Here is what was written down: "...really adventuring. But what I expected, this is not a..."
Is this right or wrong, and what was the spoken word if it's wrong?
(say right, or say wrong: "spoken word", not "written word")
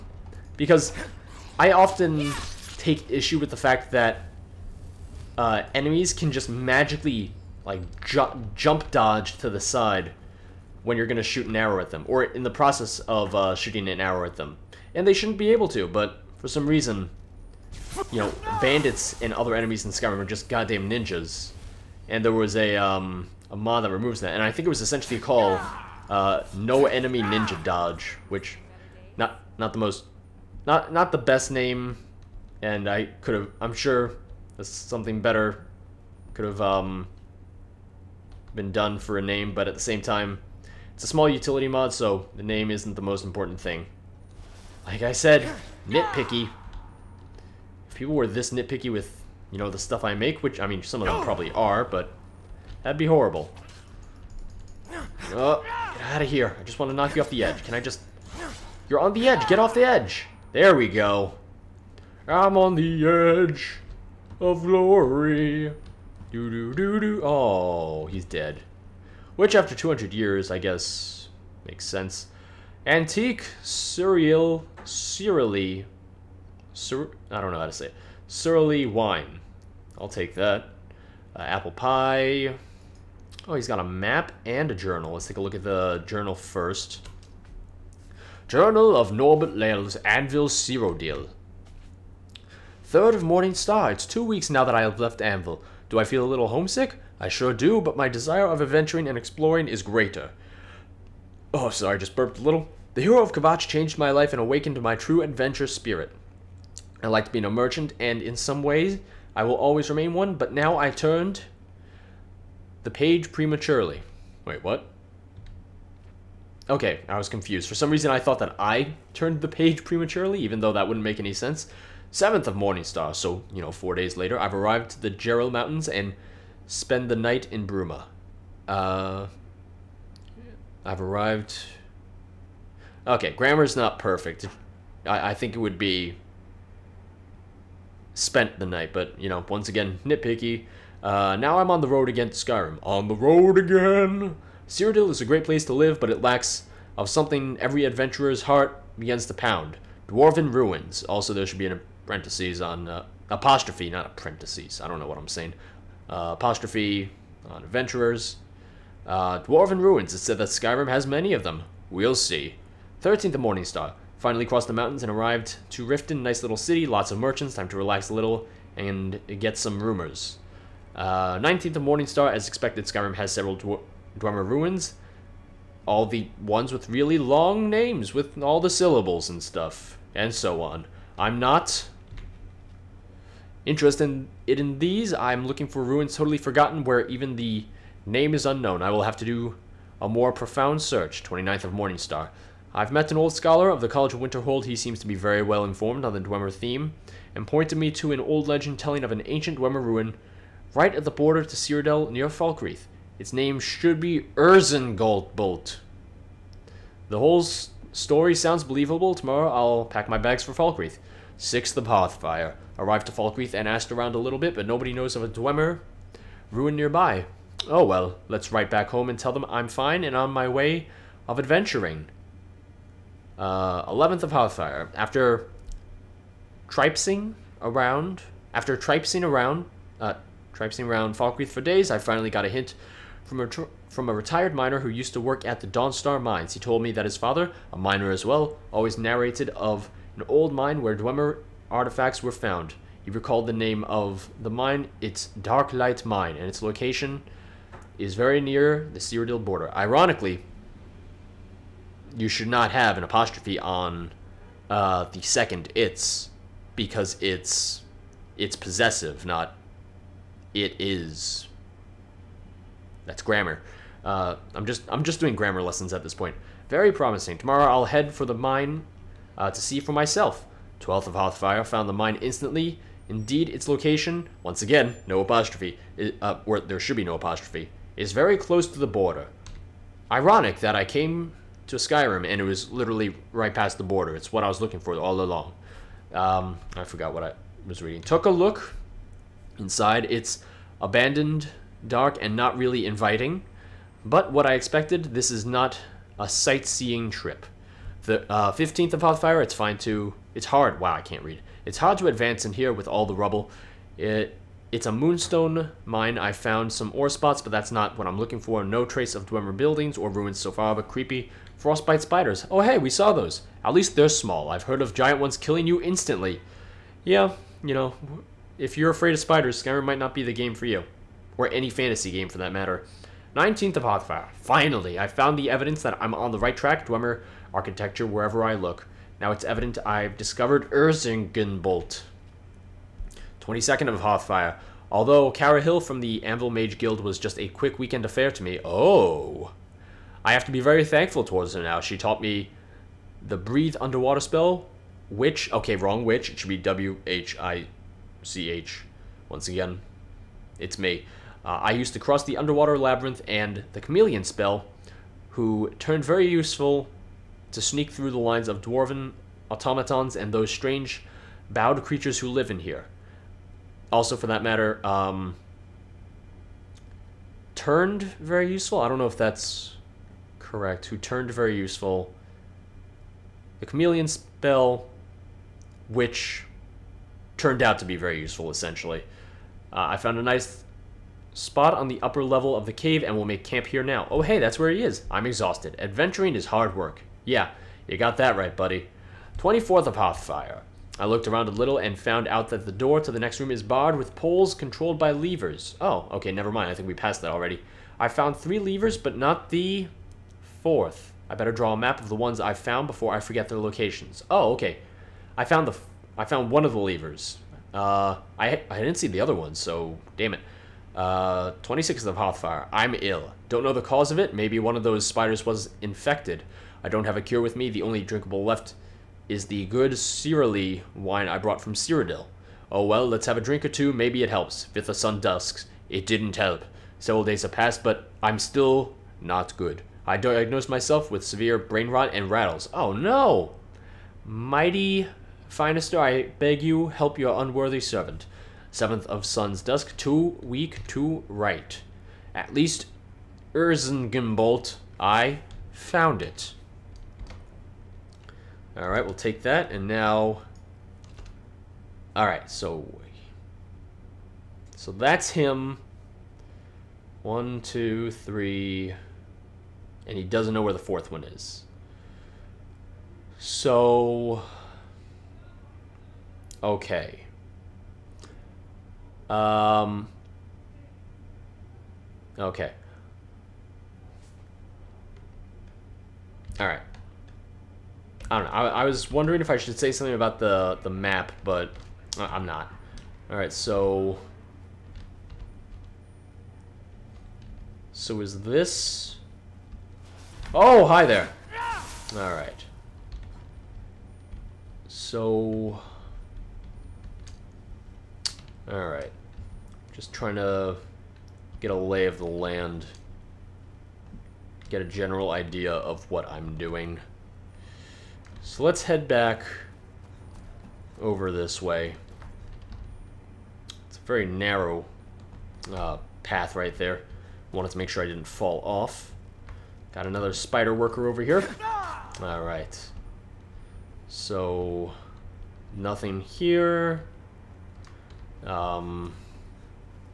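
wrong: "inviting", not "adventuring".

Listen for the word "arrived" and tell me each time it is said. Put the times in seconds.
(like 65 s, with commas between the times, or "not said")
124 s, 131 s, 165 s, 212 s.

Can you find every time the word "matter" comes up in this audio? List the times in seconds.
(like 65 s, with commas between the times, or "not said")
322 s, 364 s.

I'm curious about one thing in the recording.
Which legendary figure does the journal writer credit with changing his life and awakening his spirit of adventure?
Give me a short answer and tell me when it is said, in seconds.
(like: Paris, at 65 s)
The hero of Kvatch, at 102 s.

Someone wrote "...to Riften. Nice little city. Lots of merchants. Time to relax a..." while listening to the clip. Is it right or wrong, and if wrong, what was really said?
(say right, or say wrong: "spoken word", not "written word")
right.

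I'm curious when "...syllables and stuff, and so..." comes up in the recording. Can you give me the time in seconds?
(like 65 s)
178 s.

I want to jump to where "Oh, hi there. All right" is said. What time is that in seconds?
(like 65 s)
490 s.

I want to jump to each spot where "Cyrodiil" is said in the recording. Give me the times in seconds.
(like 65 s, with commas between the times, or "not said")
144 s, 201 s, 249 s, 421 s.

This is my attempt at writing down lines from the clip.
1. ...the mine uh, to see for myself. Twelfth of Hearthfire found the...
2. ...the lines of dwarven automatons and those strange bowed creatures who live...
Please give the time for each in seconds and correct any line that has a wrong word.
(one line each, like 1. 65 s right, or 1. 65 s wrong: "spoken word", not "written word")
1. 268 s right
2. 358 s right.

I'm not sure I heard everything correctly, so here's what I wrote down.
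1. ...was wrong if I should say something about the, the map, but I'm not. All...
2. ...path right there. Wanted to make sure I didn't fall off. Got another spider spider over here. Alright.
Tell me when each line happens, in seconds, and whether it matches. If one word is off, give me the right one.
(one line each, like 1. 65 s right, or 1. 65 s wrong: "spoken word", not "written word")
1. 478 s wrong: "wondering", not "wrong"
2. 516 s wrong: "worker", not "spider".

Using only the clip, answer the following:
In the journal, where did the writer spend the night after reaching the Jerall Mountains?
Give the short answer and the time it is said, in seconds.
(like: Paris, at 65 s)
Bruma, at 127 s.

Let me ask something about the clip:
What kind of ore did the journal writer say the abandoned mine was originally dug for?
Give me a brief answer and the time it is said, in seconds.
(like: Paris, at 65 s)
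Moonstone, at 304 s.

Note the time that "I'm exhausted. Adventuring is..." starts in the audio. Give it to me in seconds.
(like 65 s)
385 s.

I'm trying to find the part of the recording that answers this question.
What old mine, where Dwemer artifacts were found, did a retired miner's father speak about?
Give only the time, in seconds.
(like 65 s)
245 s.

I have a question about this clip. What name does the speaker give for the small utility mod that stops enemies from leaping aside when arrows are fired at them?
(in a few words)
No Enemy Ninja Dodge.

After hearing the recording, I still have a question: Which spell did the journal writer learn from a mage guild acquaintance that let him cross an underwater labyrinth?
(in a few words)
Breathe Underwater.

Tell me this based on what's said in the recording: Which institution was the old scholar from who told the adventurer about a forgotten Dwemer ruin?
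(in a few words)
College of Winterhold.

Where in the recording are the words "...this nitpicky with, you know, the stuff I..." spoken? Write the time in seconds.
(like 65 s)
48 s.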